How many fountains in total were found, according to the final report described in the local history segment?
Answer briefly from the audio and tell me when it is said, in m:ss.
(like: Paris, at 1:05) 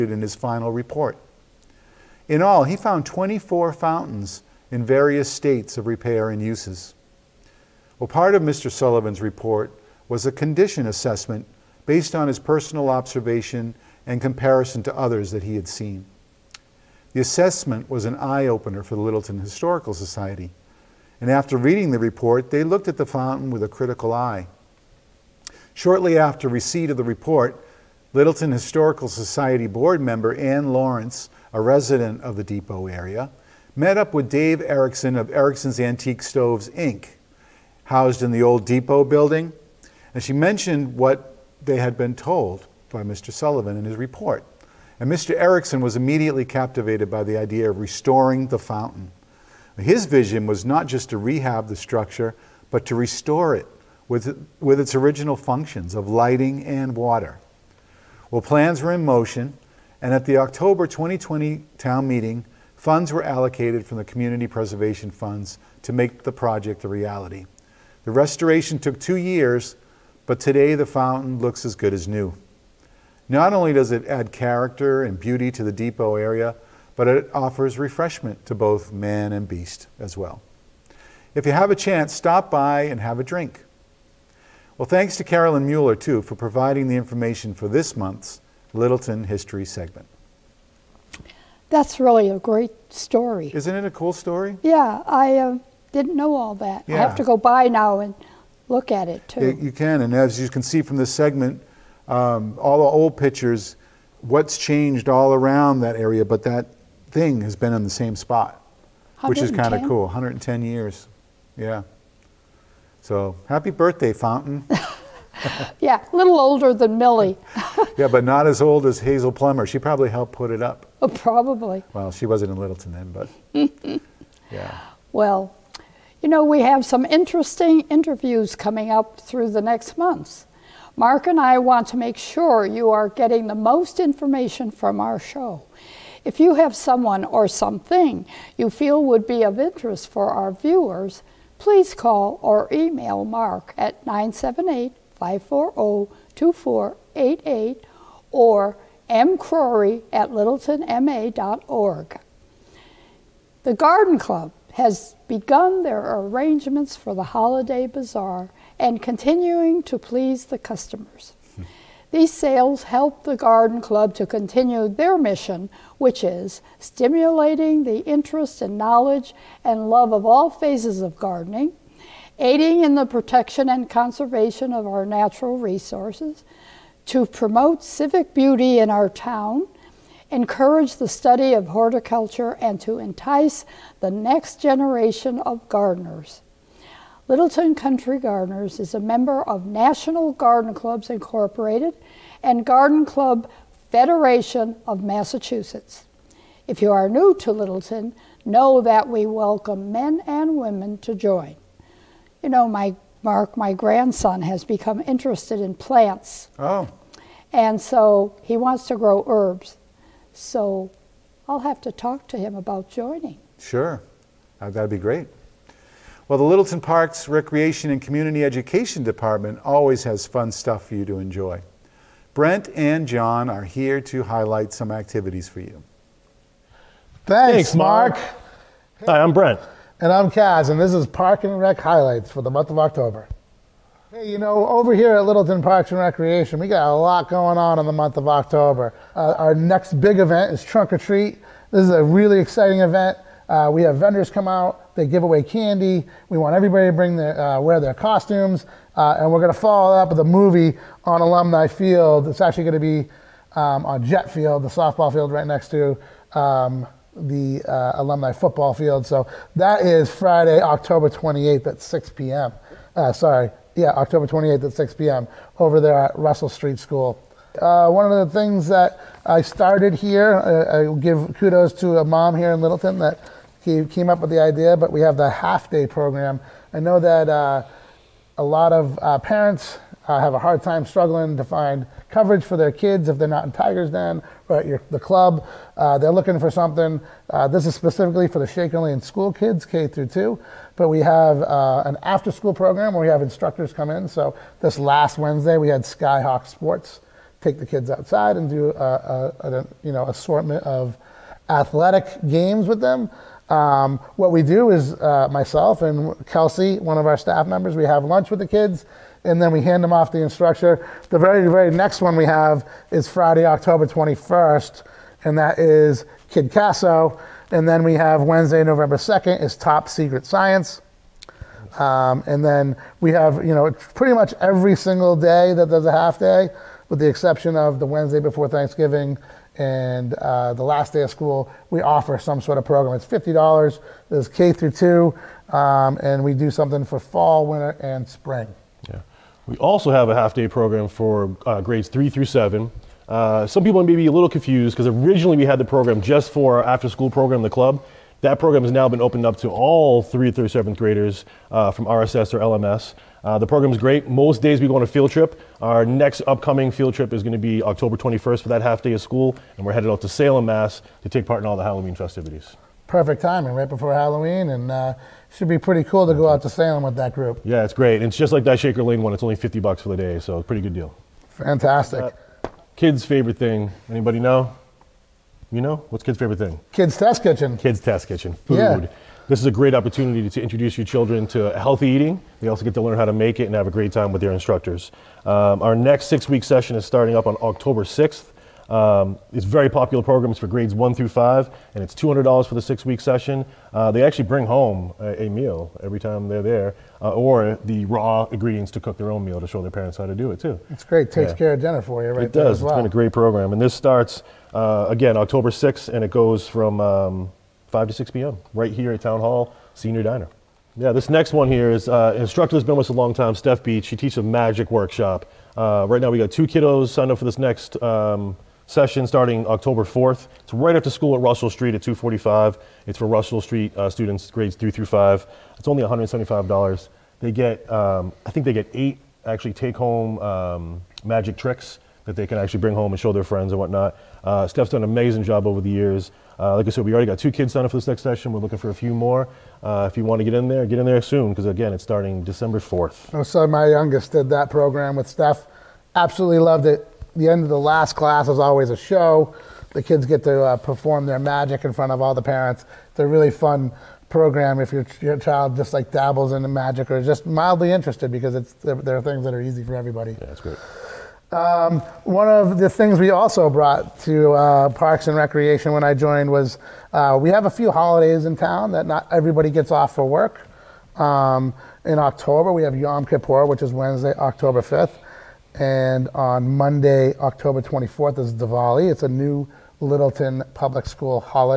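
24, at 0:03.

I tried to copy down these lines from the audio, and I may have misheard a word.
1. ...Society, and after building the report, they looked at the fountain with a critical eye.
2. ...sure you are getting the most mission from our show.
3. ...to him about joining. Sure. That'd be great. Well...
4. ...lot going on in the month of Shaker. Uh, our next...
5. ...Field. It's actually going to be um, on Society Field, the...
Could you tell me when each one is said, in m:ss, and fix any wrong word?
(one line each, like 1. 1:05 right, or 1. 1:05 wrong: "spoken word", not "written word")
1. 0:19 wrong: "reading", not "building"
2. 2:12 wrong: "information", not "mission"
3. 3:32 right
4. 3:56 wrong: "October", not "Shaker"
5. 4:11 wrong: "Jet", not "Society".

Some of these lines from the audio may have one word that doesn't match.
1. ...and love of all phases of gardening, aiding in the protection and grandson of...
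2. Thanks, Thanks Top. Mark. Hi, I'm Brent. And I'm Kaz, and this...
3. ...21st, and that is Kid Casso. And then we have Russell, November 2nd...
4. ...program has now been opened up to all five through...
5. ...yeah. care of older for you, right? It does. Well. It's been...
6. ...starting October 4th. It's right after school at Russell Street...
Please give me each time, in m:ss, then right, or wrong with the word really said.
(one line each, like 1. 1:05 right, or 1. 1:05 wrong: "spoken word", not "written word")
1. 2:49 wrong: "conservation", not "grandson"
2. 3:47 wrong: "Mark", not "Top"
3. 5:13 wrong: "Wednesday", not "Russell"
4. 5:48 wrong: "three", not "five"
5. 6:41 wrong: "dinner", not "older"
6. 6:59 right.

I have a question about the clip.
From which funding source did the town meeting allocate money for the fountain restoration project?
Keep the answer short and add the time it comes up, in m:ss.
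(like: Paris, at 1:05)
Community Preservation Funds, at 1:04.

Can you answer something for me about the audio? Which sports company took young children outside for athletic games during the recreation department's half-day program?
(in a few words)
Skyhawk Sports.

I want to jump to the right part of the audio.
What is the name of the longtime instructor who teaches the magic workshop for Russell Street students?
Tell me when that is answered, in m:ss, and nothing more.
6:53.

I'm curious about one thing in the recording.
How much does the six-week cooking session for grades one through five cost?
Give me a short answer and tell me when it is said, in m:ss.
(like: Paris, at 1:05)
$200, at 6:31.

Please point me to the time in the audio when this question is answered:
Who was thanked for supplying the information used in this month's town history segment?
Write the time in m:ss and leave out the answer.
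1:25.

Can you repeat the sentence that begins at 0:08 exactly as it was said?
Sullivan's report was a condition assessment based on his personal observation and comparison to others that he had seen.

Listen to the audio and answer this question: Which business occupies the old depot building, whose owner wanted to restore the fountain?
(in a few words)
Erickson's Antique Stoves, Inc.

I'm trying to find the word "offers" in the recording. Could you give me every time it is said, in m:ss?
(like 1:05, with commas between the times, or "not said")
1:17, 5:31.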